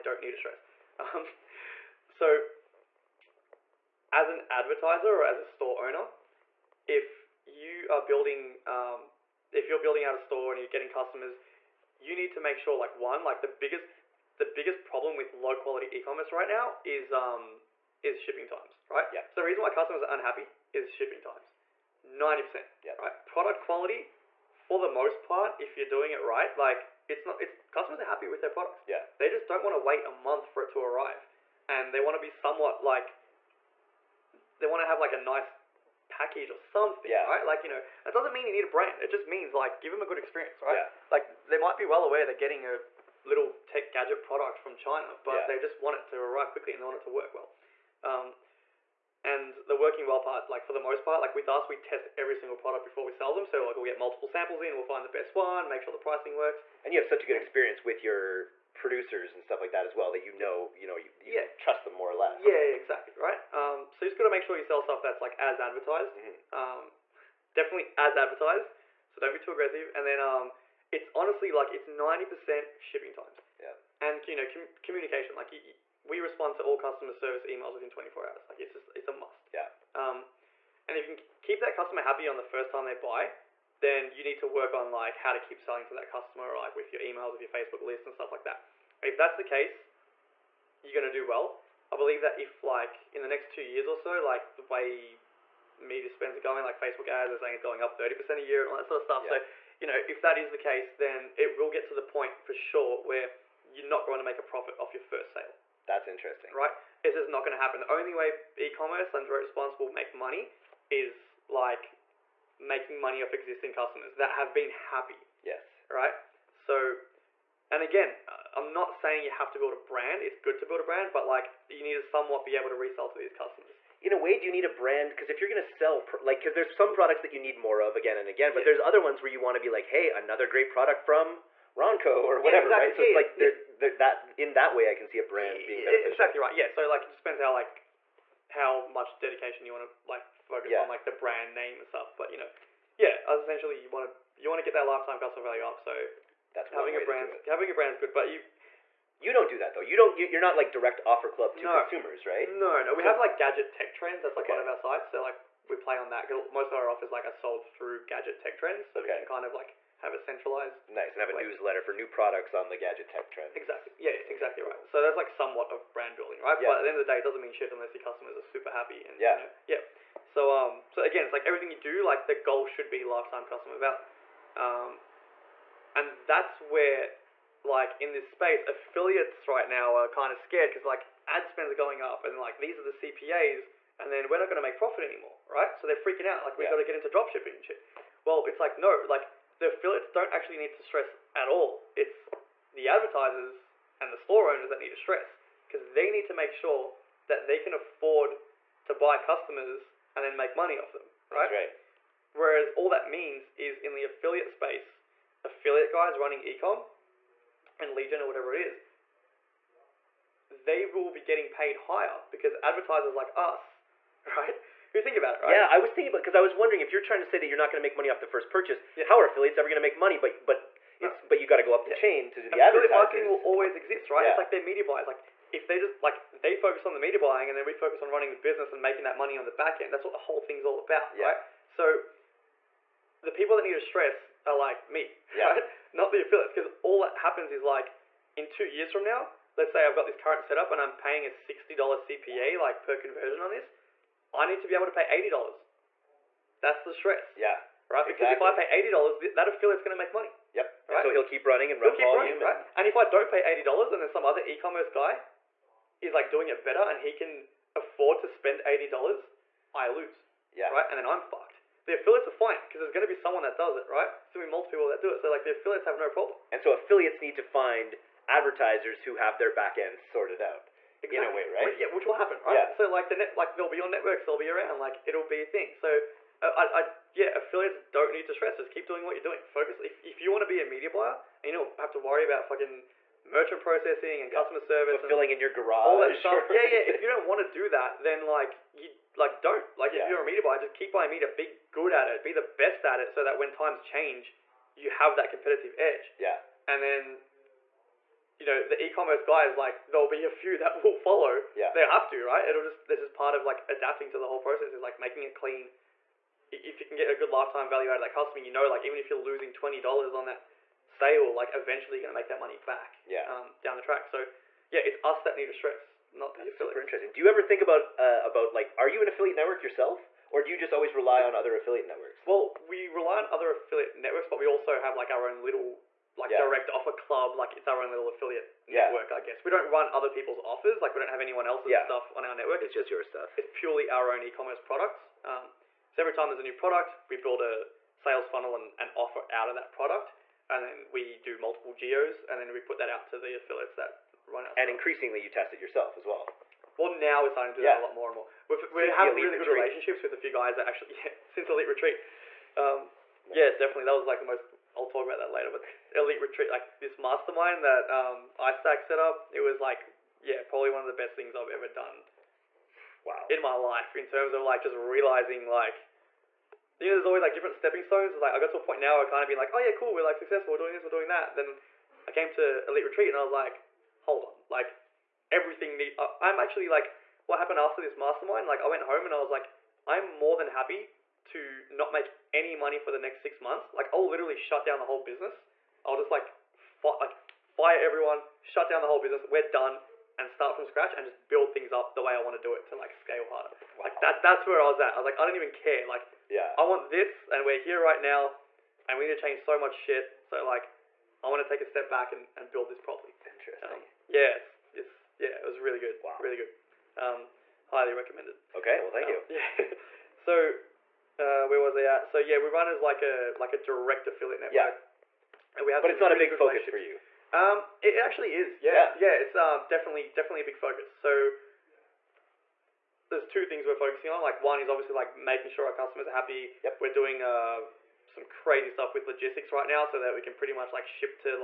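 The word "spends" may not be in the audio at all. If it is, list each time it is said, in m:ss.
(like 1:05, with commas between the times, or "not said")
1:36, 3:01, 4:18.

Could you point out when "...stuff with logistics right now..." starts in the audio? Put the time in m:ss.
7:08.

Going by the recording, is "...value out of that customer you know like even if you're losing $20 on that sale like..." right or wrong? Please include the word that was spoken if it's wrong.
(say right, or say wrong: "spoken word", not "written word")
right.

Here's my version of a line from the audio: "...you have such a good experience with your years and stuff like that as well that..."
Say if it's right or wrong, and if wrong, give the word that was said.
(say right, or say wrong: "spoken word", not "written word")
wrong: "producers", not "years".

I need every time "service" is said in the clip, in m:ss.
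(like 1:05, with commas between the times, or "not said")
1:17, 4:44.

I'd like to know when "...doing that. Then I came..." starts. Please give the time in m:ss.
6:10.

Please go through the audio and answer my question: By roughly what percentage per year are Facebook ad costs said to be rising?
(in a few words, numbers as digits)
30%.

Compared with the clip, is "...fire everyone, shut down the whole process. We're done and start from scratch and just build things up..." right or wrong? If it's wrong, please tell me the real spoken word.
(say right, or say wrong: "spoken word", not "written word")
wrong: "business", not "process".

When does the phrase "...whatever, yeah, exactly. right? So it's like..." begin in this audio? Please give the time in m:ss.
2:12.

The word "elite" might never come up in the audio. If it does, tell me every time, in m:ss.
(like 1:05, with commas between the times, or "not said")
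5:51, 5:55, 6:12.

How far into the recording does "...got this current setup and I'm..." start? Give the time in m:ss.
3:59.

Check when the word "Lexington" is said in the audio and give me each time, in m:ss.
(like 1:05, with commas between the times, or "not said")
not said.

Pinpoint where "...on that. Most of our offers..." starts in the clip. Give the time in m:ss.
2:35.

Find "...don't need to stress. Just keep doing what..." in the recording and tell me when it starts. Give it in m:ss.
4:37.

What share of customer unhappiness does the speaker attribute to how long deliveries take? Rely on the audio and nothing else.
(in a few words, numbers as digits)
90%.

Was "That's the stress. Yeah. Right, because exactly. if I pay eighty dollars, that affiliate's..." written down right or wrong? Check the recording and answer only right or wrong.
right.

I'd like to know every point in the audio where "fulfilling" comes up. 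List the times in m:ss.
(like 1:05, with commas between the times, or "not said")
4:45.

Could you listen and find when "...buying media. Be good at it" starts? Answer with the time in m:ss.
4:50.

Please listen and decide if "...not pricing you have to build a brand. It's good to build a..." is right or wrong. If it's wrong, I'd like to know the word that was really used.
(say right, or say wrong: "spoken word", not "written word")
wrong: "saying", not "pricing".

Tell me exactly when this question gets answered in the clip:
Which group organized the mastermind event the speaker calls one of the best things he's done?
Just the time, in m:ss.
5:58.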